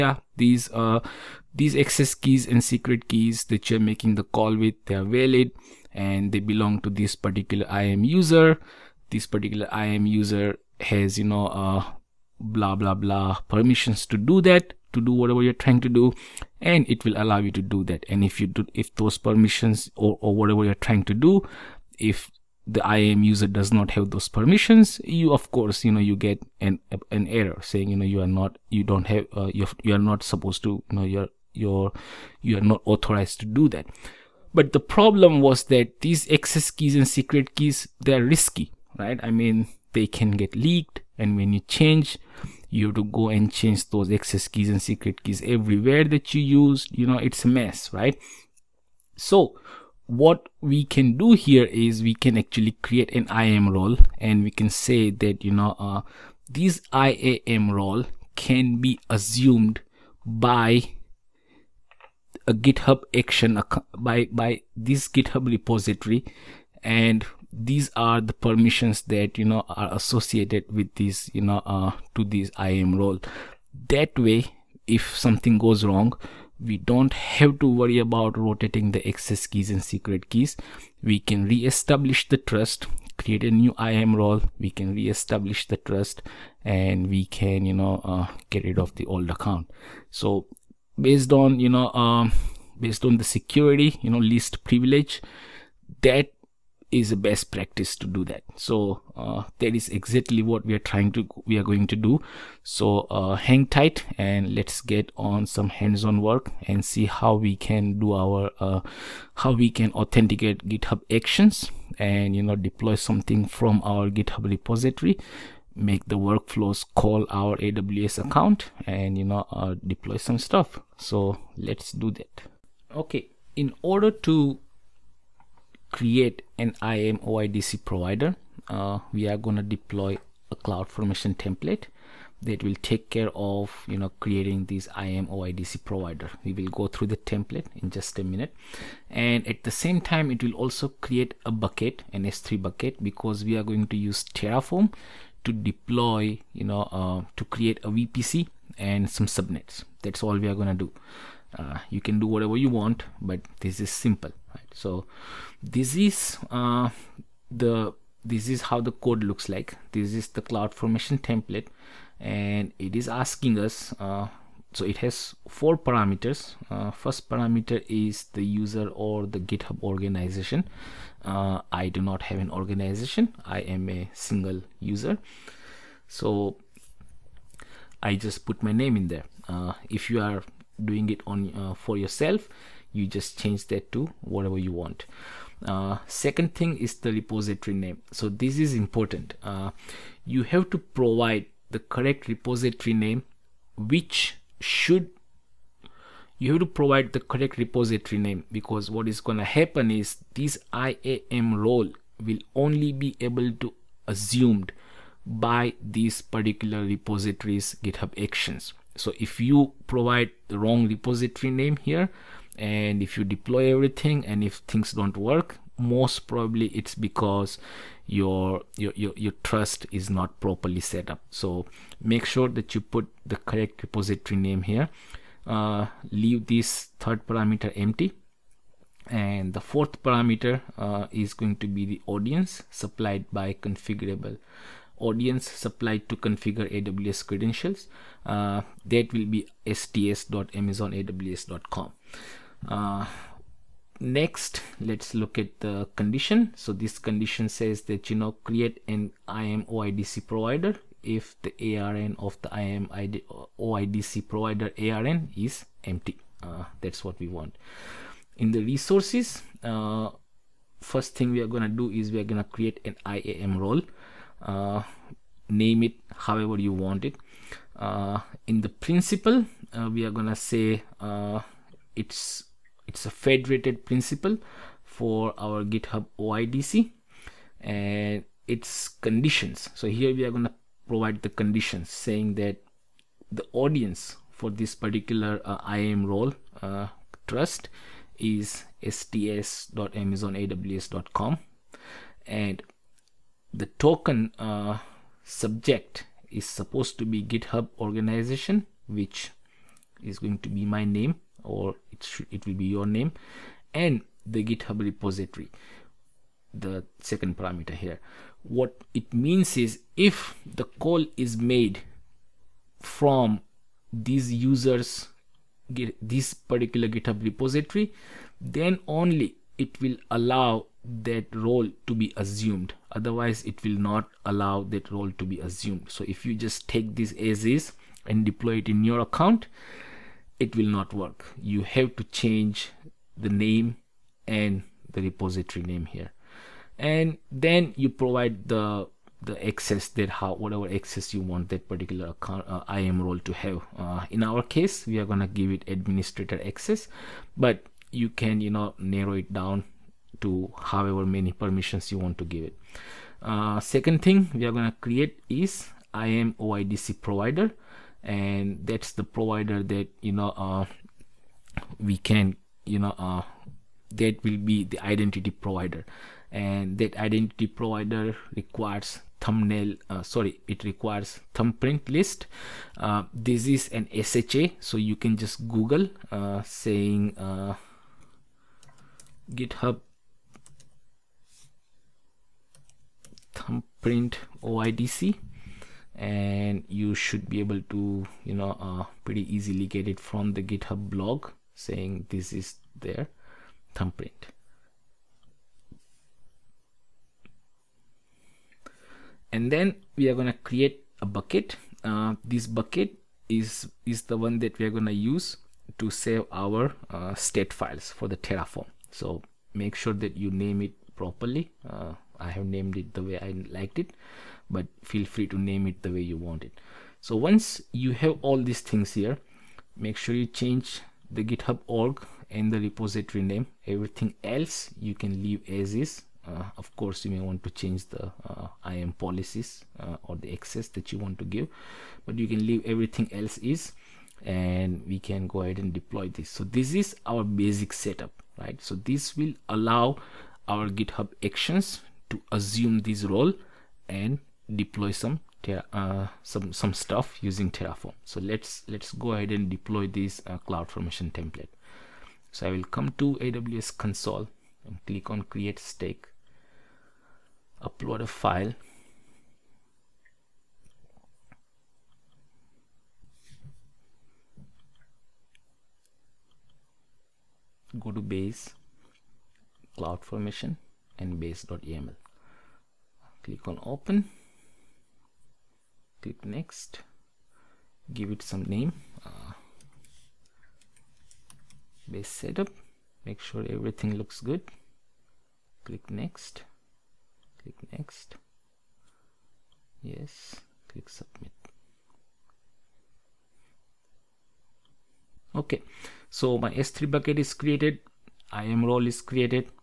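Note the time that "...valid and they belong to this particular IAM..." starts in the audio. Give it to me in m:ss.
0:05.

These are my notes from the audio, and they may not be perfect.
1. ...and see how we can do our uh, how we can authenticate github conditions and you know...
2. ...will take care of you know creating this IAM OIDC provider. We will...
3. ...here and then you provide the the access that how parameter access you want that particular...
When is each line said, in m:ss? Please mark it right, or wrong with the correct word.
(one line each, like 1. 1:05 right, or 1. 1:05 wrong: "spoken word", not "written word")
1. 1:46 wrong: "actions", not "conditions"
2. 2:12 right
3. 5:35 wrong: "whatever", not "parameter".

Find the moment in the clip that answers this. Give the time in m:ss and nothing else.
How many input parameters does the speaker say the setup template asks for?
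2:45.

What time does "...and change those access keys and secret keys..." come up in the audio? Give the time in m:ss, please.
0:43.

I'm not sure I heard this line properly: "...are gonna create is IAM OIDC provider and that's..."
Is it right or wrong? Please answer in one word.
right.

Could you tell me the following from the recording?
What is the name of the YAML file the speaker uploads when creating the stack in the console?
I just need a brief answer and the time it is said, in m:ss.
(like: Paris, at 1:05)
base.yaml, at 7:51.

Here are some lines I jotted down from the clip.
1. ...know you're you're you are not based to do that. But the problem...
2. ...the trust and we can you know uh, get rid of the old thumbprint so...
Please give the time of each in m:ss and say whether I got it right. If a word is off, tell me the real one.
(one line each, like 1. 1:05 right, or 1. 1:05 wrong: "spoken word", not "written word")
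1. 0:30 wrong: "authorized", not "based"
2. 1:25 wrong: "account", not "thumbprint".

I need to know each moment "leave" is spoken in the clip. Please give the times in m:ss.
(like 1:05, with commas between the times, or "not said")
3:46, 7:05, 7:12.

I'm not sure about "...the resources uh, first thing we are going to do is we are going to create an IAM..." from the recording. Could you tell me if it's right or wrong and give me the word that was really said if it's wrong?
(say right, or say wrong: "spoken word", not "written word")
right.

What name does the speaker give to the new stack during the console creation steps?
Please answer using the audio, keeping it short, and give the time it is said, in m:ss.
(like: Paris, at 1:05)
base setup, at 8:01.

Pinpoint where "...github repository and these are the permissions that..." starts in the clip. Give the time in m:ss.
1:05.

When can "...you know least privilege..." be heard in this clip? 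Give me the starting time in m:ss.
1:34.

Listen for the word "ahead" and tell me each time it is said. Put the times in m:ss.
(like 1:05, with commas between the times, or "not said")
7:15, 7:29.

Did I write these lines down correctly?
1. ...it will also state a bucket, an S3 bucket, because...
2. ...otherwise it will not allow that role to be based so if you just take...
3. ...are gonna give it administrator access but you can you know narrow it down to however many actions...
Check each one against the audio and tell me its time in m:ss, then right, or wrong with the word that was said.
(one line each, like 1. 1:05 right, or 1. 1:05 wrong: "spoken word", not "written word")
1. 2:20 wrong: "create", not "state"
2. 5:22 wrong: "assumed", not "based"
3. 5:44 wrong: "permissions", not "actions".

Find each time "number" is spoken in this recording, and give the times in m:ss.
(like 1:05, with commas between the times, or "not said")
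not said.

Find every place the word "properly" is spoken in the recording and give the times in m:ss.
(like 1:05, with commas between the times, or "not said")
3:40, 6:50.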